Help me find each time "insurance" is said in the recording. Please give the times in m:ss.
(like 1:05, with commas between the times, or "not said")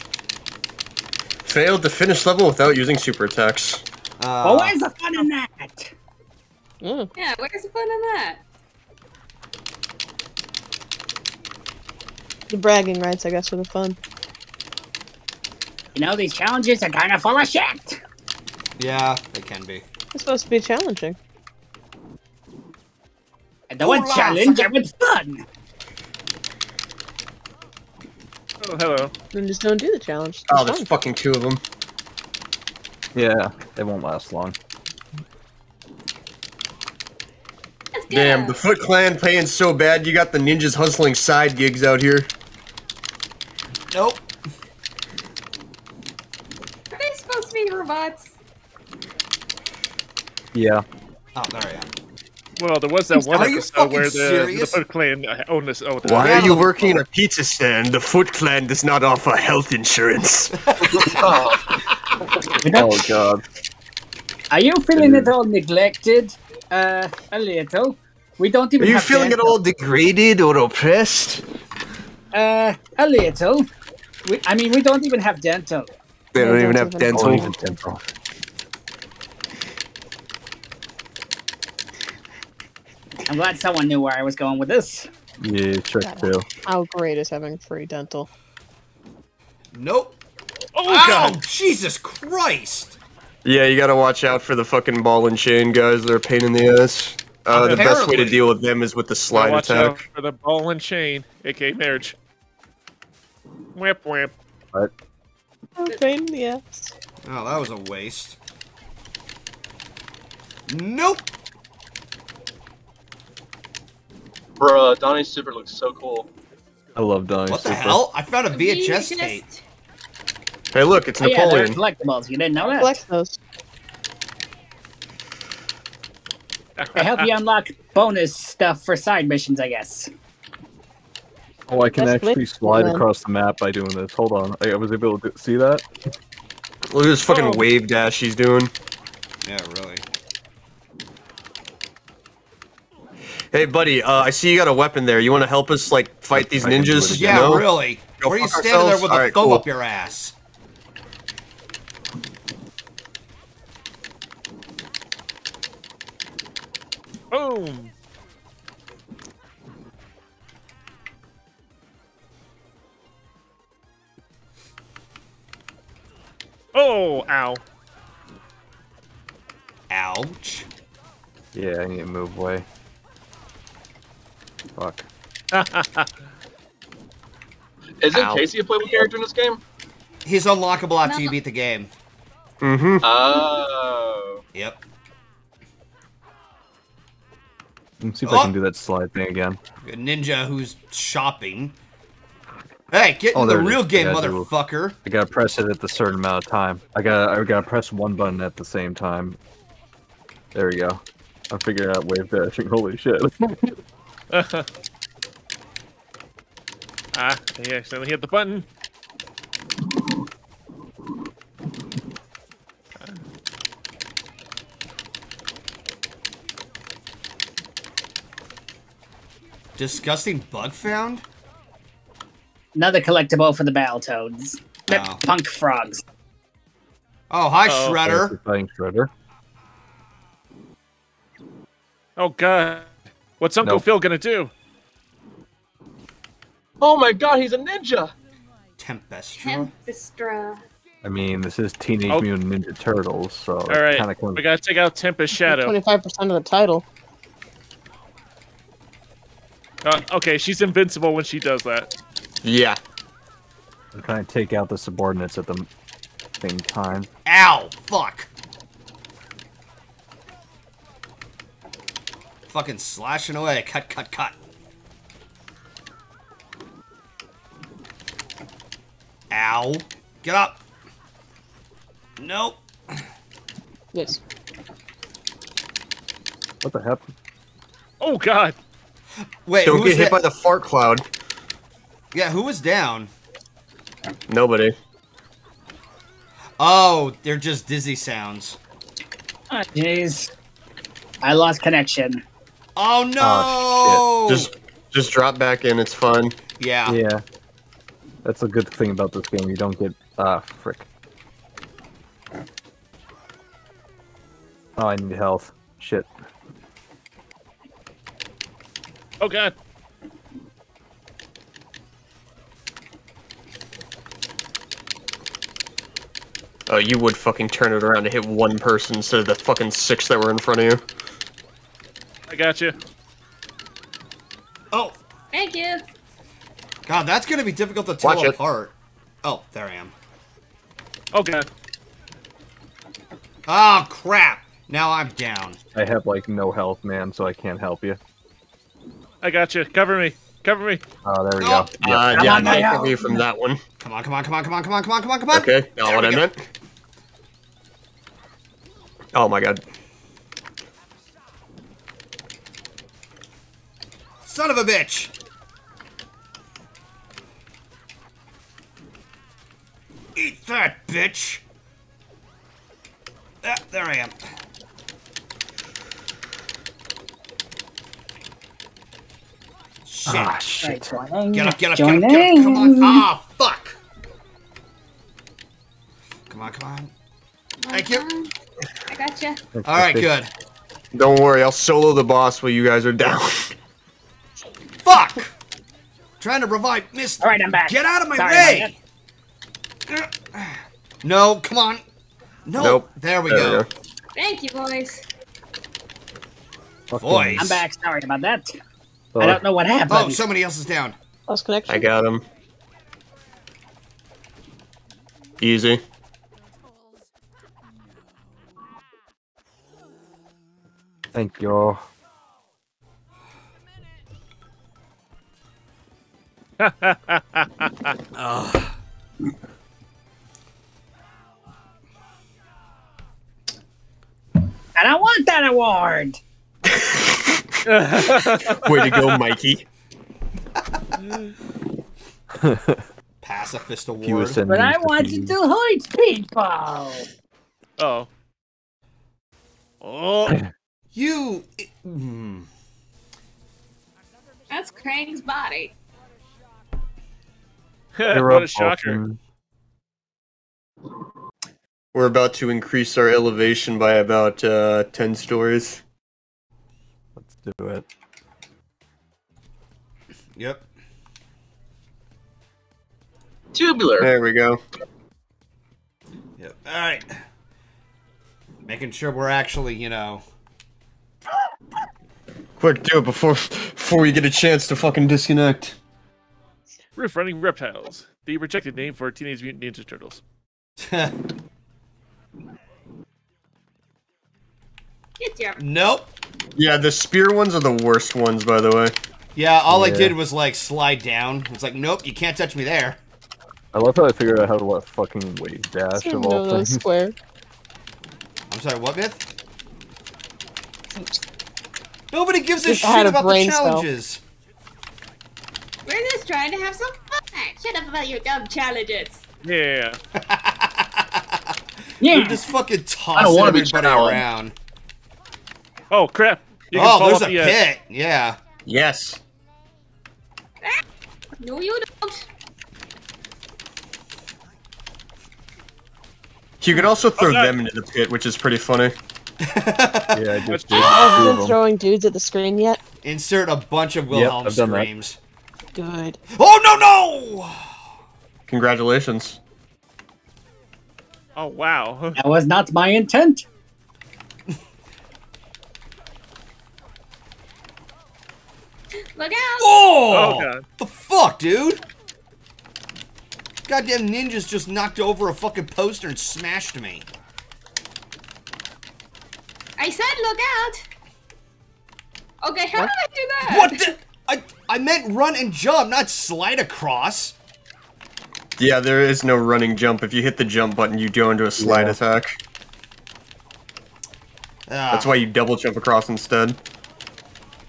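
0:59.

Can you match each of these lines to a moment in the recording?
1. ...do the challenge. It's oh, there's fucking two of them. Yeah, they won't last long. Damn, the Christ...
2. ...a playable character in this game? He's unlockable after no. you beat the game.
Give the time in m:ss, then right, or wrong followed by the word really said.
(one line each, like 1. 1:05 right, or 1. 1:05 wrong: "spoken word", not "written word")
1. 0:29 wrong: "Foot", not "Christ"
2. 2:58 right.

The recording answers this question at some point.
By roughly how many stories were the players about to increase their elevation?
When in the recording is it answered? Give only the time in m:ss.
7:34.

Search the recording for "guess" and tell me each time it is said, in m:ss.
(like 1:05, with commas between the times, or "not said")
0:13, 2:09.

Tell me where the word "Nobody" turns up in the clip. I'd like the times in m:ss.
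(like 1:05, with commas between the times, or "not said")
4:44, 8:22.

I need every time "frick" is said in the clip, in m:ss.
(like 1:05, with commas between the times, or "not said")
5:00.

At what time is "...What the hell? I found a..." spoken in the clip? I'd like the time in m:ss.
1:57.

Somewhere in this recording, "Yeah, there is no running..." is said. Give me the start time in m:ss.
9:28.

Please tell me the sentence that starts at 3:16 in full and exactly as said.
I gotta I gotta press one button at the same time.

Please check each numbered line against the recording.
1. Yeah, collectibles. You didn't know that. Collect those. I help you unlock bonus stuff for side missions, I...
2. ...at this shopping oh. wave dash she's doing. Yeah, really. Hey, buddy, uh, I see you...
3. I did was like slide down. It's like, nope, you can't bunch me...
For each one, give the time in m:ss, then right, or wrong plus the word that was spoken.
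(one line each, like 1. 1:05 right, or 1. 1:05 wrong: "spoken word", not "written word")
1. 2:01 right
2. 2:17 wrong: "fucking", not "shopping"
3. 8:09 wrong: "touch", not "bunch".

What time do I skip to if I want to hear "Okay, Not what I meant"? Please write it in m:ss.
5:45.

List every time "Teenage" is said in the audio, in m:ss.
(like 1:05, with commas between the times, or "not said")
4:01, 7:59.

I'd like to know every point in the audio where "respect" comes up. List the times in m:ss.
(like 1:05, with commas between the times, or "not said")
not said.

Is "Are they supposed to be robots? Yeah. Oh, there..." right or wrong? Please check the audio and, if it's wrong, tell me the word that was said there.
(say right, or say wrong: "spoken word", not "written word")
right.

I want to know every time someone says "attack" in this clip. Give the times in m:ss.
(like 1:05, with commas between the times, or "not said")
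0:03, 1:39, 9:31.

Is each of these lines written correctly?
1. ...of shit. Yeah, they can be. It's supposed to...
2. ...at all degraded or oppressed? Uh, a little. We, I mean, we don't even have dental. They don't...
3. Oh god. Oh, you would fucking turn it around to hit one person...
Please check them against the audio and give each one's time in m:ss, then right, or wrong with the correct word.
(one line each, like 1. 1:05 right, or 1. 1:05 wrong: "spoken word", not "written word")
1. 0:17 right
2. 1:09 right
3. 5:09 right.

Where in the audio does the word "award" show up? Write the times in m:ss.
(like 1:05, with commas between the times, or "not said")
7:05, 7:13.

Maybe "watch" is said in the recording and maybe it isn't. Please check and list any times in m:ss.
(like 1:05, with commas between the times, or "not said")
1:33, 1:39, 5:28.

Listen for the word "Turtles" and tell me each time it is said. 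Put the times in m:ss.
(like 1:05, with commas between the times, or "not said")
4:02, 7:59.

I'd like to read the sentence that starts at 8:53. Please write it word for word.
Insert a bunch of Wilhelm yep, screams.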